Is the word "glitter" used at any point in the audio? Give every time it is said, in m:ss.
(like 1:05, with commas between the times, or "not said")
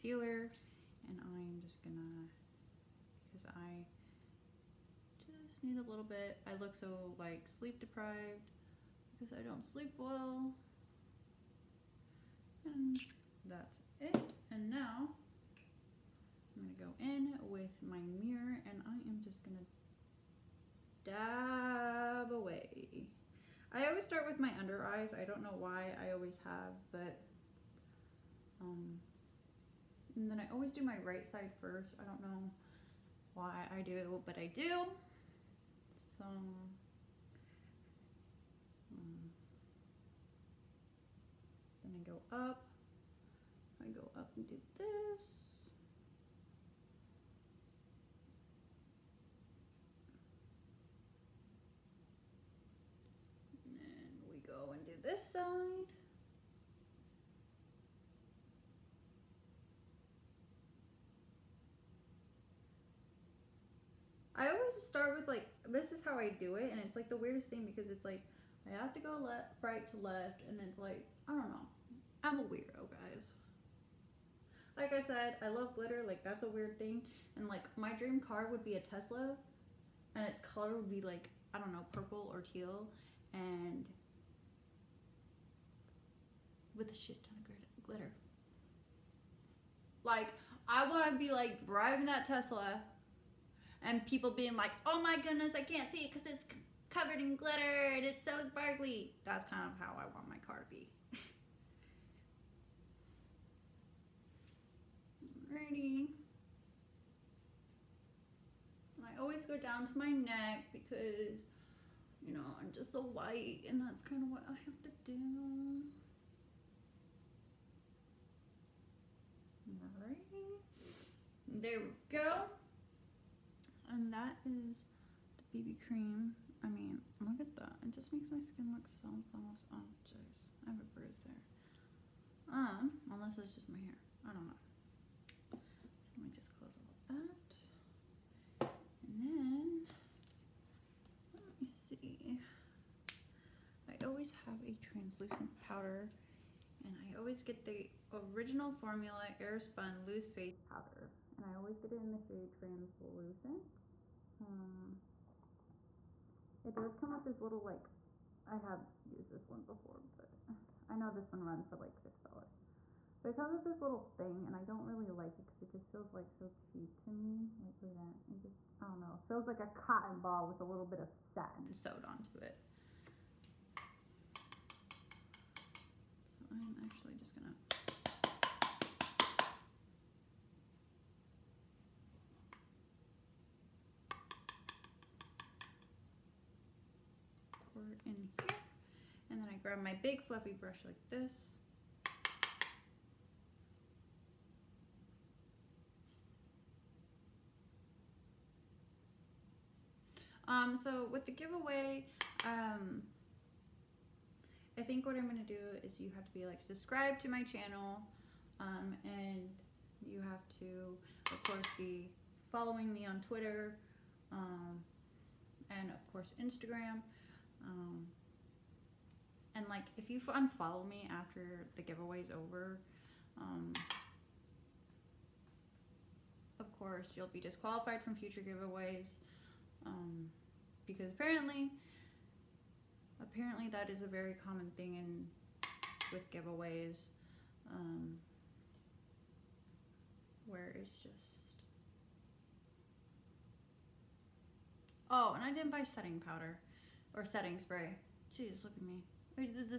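1:15, 1:27, 1:37.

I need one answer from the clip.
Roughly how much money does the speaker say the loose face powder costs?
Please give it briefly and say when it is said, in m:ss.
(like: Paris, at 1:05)
$6, at 2:41.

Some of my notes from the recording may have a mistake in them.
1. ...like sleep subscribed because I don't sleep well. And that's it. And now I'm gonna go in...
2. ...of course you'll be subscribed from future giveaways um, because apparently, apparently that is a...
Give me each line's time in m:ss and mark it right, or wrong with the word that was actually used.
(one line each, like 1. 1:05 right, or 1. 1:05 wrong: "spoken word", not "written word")
1. 0:07 wrong: "deprived", not "subscribed"
2. 3:46 wrong: "disqualified", not "subscribed".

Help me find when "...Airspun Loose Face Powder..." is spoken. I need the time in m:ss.
2:29.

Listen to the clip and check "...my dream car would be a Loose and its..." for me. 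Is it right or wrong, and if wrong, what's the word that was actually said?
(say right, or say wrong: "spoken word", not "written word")
wrong: "Tesla", not "Loose".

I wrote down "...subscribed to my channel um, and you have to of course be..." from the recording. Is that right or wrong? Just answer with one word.
right.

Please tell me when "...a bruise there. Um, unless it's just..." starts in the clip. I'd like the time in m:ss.
2:10.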